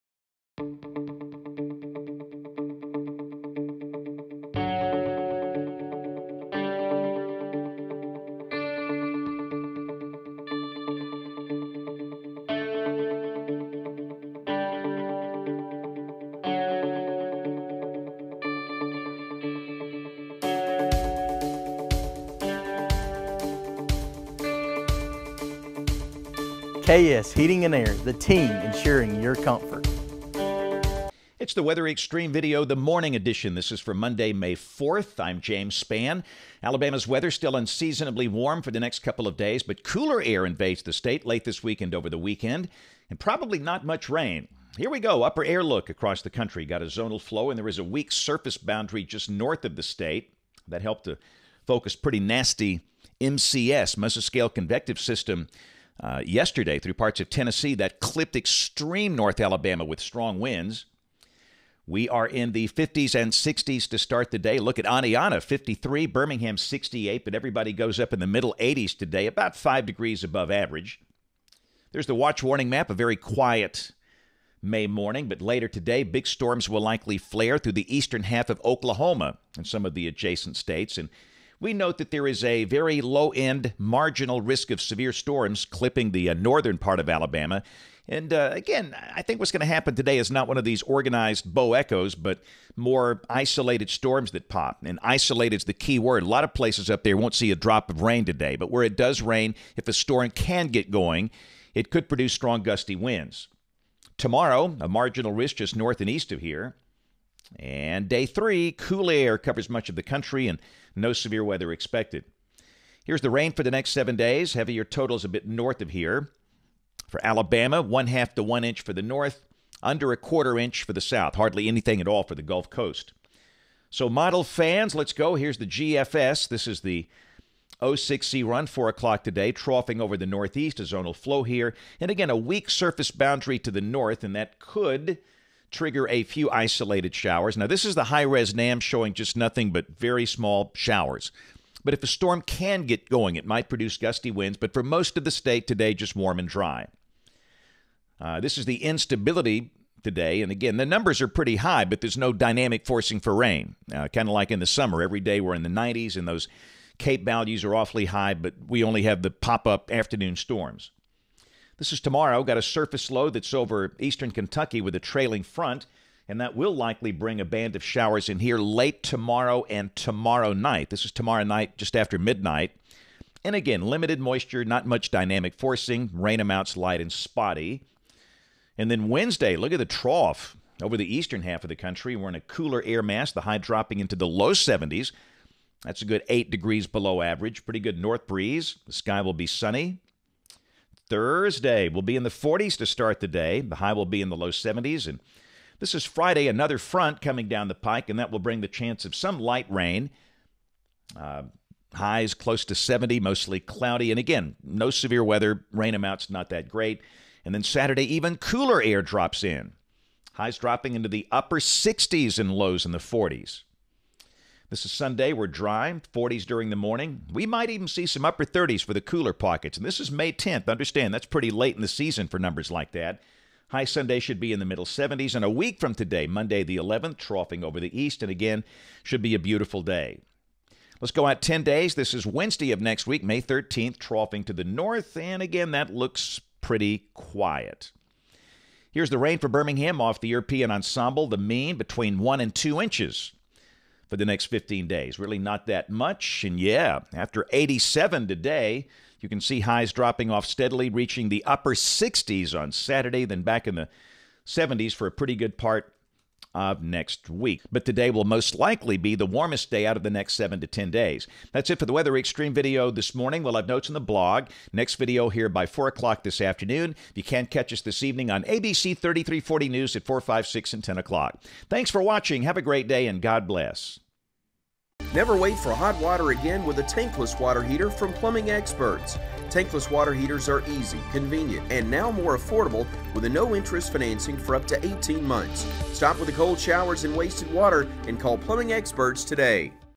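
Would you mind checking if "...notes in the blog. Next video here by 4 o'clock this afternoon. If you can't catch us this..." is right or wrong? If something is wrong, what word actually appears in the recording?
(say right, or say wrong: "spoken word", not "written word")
right.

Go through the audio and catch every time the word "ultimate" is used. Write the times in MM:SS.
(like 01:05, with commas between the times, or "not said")
not said.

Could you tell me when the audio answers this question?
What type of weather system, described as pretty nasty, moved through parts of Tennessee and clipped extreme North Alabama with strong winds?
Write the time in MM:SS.
00:53.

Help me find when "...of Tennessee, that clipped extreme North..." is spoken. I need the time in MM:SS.
00:57.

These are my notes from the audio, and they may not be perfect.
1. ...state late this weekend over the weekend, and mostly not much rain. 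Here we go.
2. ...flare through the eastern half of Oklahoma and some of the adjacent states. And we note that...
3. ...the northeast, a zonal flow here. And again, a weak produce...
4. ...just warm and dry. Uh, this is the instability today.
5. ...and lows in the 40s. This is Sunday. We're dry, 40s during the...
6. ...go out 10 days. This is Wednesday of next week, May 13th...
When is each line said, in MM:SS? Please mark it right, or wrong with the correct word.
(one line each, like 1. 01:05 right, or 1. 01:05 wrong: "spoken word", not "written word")
1. 00:40 wrong: "probably", not "mostly"
2. 01:17 right
3. 02:10 wrong: "surface", not "produce"
4. 02:25 right
5. 03:32 right
6. 03:51 right.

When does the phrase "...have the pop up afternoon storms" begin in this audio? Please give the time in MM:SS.
02:39.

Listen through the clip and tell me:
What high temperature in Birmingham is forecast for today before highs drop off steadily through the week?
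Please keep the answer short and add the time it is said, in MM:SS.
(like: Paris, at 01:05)
87, at 04:07.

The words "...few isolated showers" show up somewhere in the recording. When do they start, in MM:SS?
02:16.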